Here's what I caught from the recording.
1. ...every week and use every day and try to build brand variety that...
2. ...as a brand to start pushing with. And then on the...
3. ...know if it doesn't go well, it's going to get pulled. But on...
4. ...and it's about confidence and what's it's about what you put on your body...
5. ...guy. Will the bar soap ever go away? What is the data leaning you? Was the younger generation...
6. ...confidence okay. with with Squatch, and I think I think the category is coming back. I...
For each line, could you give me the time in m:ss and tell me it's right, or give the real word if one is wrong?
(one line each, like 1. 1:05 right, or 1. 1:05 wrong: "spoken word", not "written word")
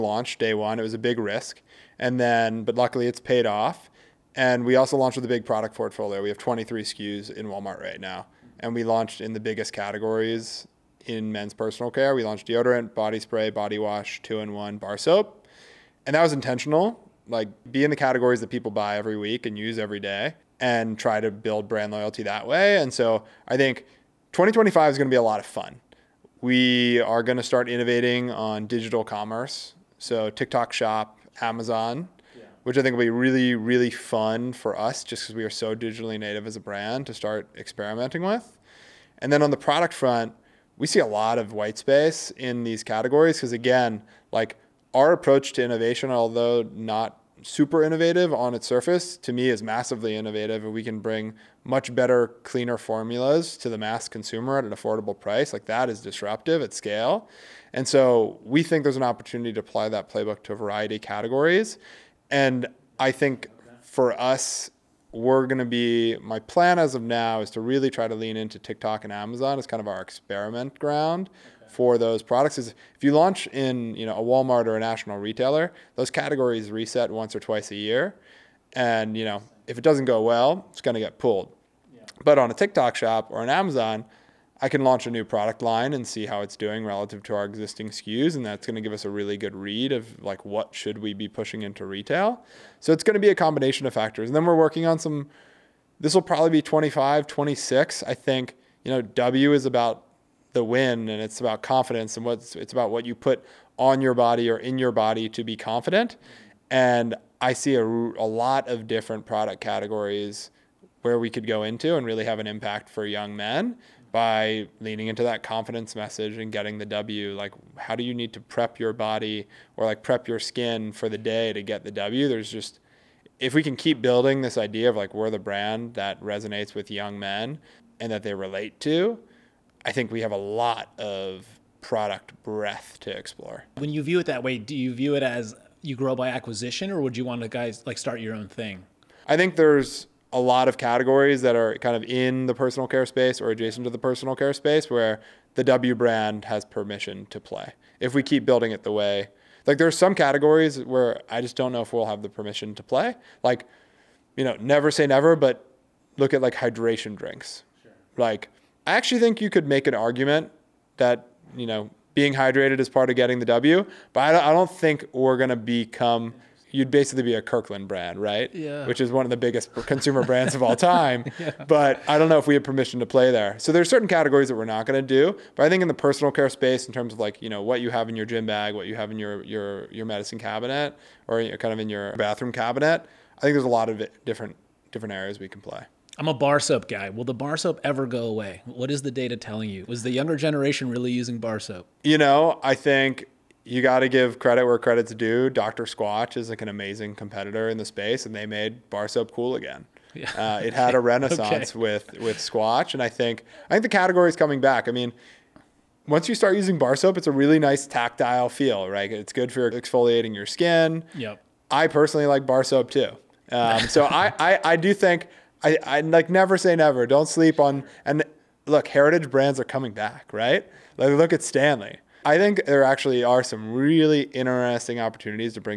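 1. 0:18 wrong: "loyalty", not "variety"
2. 0:36 wrong: "experimenting", not "pushing"
3. 1:19 right
4. 1:41 right
5. 3:06 wrong: "telling", not "leaning"
6. 3:20 wrong: "renaissance", not "confidence".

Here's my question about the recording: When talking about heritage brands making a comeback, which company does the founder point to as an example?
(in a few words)
Stanley.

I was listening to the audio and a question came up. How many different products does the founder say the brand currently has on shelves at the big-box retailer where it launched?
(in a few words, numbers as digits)
23.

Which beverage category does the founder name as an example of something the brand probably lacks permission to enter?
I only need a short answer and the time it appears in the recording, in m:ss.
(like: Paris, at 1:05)
hydration drinks, at 2:36.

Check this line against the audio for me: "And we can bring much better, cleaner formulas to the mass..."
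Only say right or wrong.
right.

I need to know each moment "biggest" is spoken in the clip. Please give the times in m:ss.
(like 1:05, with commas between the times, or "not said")
0:09, 2:49.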